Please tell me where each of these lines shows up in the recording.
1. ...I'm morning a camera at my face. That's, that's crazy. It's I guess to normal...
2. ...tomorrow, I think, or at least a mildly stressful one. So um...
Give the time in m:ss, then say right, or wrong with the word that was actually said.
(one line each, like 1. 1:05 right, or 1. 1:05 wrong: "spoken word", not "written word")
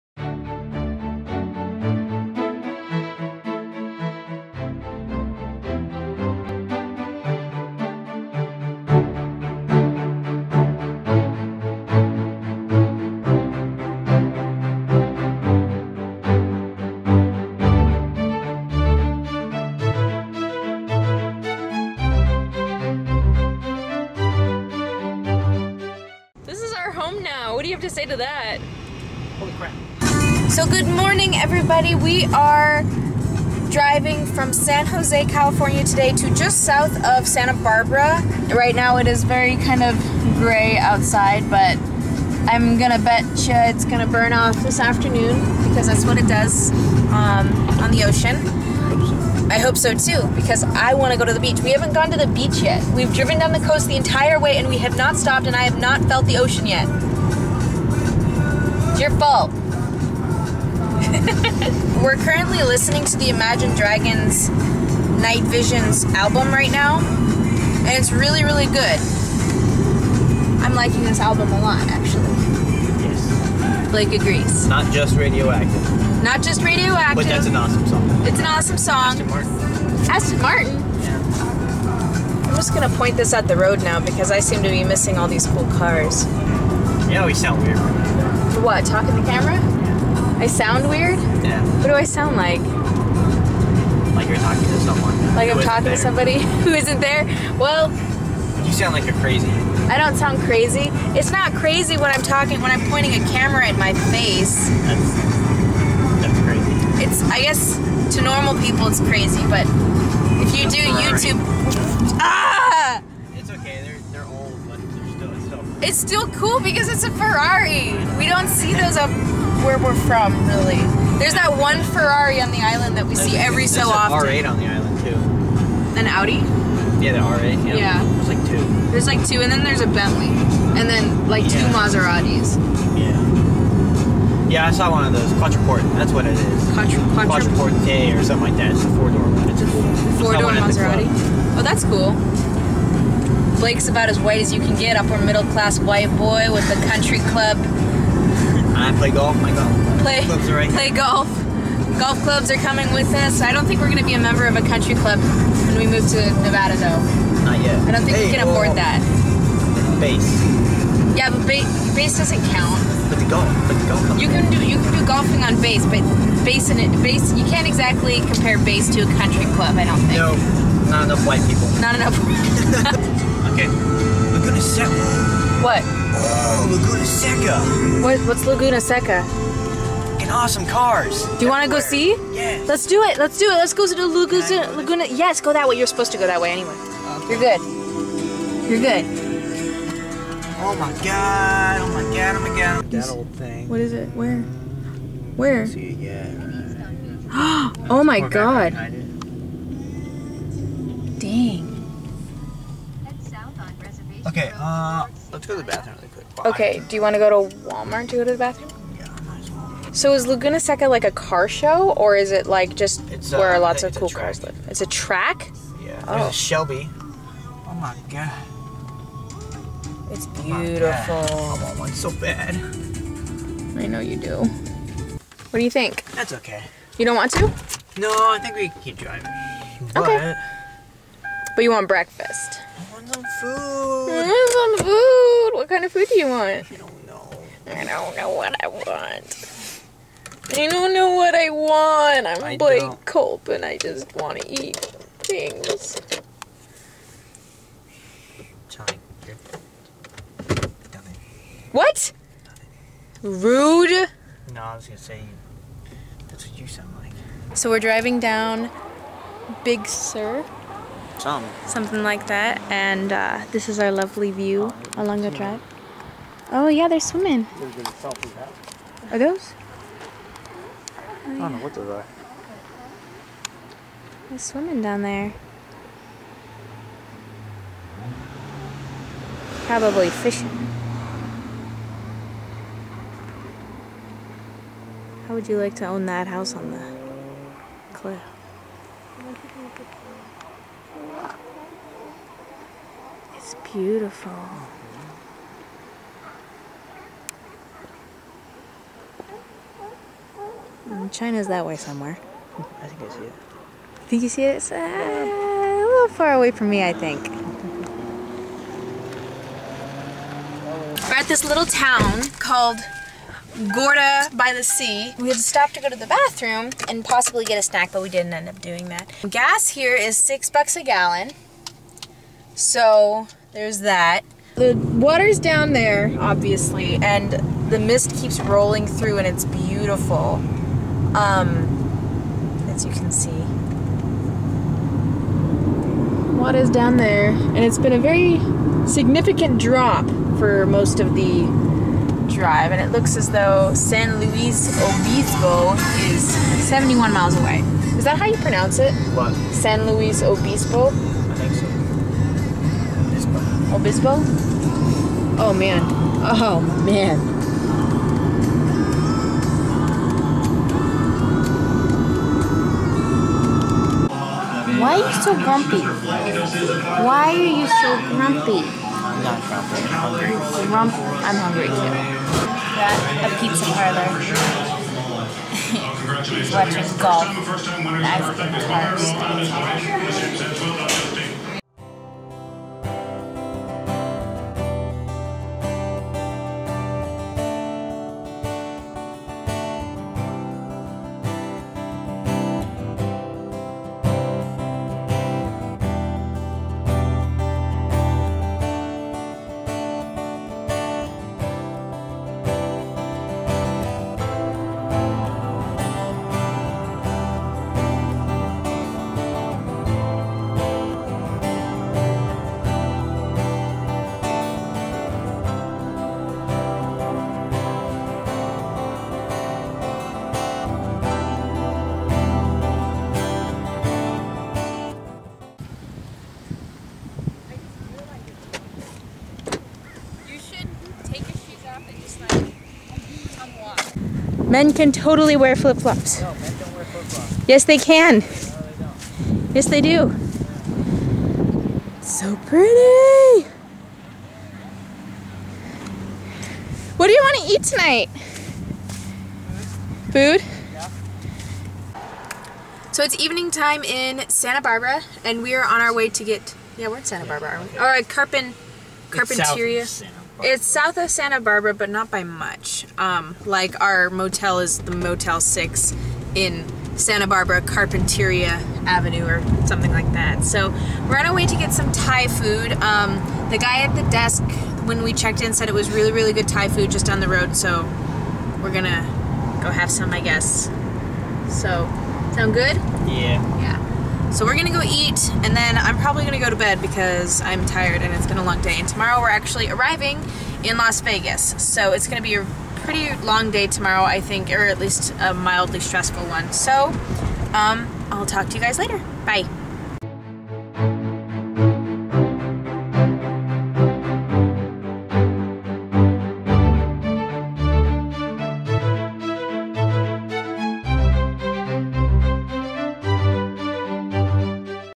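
1. 1:42 wrong: "pointing", not "morning"
2. 8:13 right.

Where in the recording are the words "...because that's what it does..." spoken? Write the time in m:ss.
0:45.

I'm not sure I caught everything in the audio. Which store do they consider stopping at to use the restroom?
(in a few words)
Walmart.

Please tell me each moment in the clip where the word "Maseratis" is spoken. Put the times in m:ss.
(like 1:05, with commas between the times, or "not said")
2:11, 2:20.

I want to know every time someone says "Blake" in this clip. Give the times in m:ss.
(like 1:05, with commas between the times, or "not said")
1:13, 2:23, 4:02.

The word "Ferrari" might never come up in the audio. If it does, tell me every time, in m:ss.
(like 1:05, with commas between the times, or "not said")
1:57, 2:01.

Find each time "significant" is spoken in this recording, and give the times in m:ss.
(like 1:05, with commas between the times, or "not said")
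5:38.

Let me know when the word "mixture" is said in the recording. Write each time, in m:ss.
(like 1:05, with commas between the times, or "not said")
not said.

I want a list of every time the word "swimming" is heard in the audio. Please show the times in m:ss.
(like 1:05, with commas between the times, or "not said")
4:26, 4:34.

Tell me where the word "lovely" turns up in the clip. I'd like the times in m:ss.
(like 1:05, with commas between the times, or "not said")
4:23.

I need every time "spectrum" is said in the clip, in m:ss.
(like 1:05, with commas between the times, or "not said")
not said.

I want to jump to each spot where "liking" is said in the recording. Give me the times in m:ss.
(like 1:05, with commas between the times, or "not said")
1:10.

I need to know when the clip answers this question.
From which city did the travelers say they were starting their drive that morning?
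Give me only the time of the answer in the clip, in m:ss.
0:34.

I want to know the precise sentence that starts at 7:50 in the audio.
So we're on our way to get some Thai food.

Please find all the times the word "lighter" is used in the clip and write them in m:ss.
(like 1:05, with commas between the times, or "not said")
not said.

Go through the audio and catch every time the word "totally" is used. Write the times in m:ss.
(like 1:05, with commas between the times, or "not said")
7:14.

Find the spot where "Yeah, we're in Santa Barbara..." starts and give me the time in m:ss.
7:36.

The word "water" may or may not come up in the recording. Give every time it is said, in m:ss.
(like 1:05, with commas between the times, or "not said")
5:24, 5:36.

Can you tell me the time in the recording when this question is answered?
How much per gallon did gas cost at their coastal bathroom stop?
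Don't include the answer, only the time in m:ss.
5:20.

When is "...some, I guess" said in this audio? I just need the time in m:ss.
7:59.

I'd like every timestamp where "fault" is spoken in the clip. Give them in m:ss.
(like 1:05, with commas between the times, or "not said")
0:59.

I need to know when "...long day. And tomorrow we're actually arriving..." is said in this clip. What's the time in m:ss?
8:08.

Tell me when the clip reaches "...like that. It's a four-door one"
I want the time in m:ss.
2:18.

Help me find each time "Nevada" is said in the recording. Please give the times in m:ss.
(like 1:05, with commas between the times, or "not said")
2:36.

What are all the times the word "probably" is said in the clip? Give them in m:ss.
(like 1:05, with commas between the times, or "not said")
4:39, 8:05.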